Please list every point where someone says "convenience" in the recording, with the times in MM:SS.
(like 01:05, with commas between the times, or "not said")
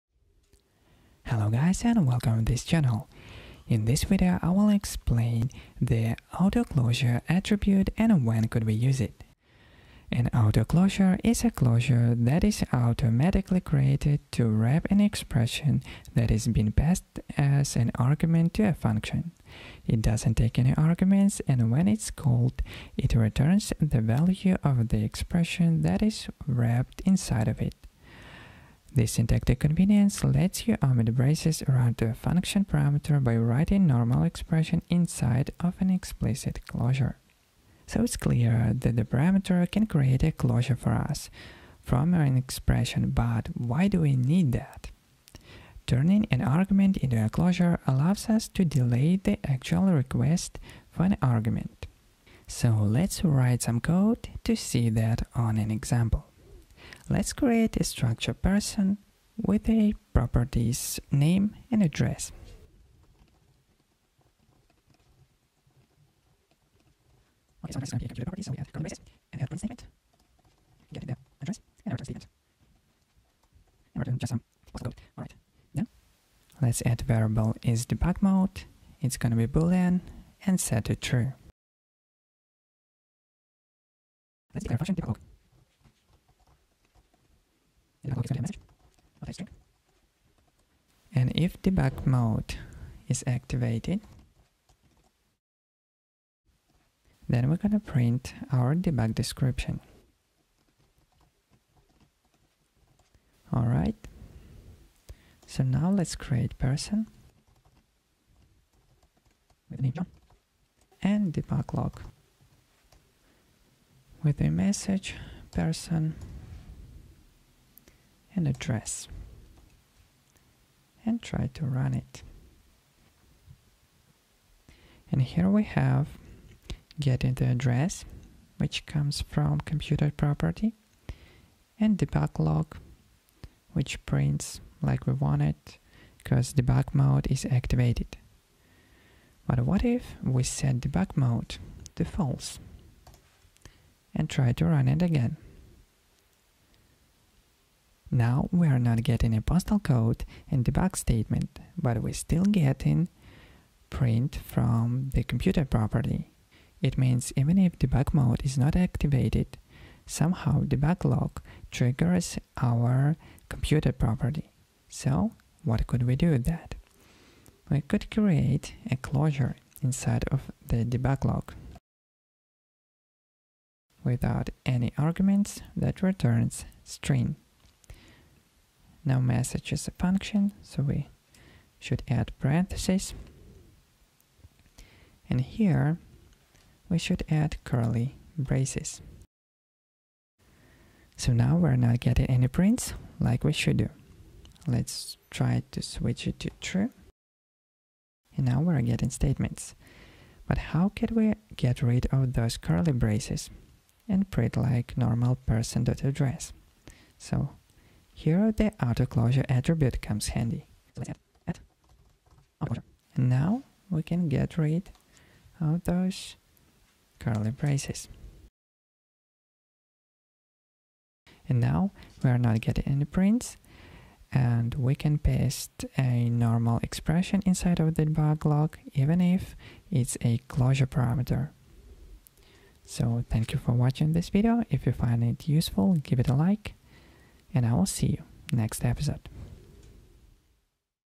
00:29.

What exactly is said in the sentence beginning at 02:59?
Now message is a function, so we should add parentheses.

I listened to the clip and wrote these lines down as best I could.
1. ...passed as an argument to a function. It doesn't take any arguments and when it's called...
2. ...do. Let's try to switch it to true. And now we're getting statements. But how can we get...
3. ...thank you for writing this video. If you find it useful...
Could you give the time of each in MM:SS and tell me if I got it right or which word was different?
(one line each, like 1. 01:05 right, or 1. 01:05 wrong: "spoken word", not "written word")
1. 00:16 right
2. 03:13 right
3. 03:53 wrong: "watching", not "writing".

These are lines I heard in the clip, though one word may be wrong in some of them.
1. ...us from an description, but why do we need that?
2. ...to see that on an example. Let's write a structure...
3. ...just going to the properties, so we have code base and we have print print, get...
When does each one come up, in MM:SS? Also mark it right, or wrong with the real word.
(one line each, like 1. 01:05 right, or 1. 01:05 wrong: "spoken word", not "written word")
1. 00:40 wrong: "expression", not "description"
2. 00:54 wrong: "create", not "write"
3. 01:07 wrong: "statement", not "print".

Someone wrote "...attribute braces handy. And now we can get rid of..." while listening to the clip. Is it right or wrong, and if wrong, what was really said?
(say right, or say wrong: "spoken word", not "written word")
wrong: "comes", not "braces".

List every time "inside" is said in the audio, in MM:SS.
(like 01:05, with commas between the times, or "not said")
00:27, 00:34, 02:49, 03:47.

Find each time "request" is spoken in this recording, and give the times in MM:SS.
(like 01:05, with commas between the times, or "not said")
00:49.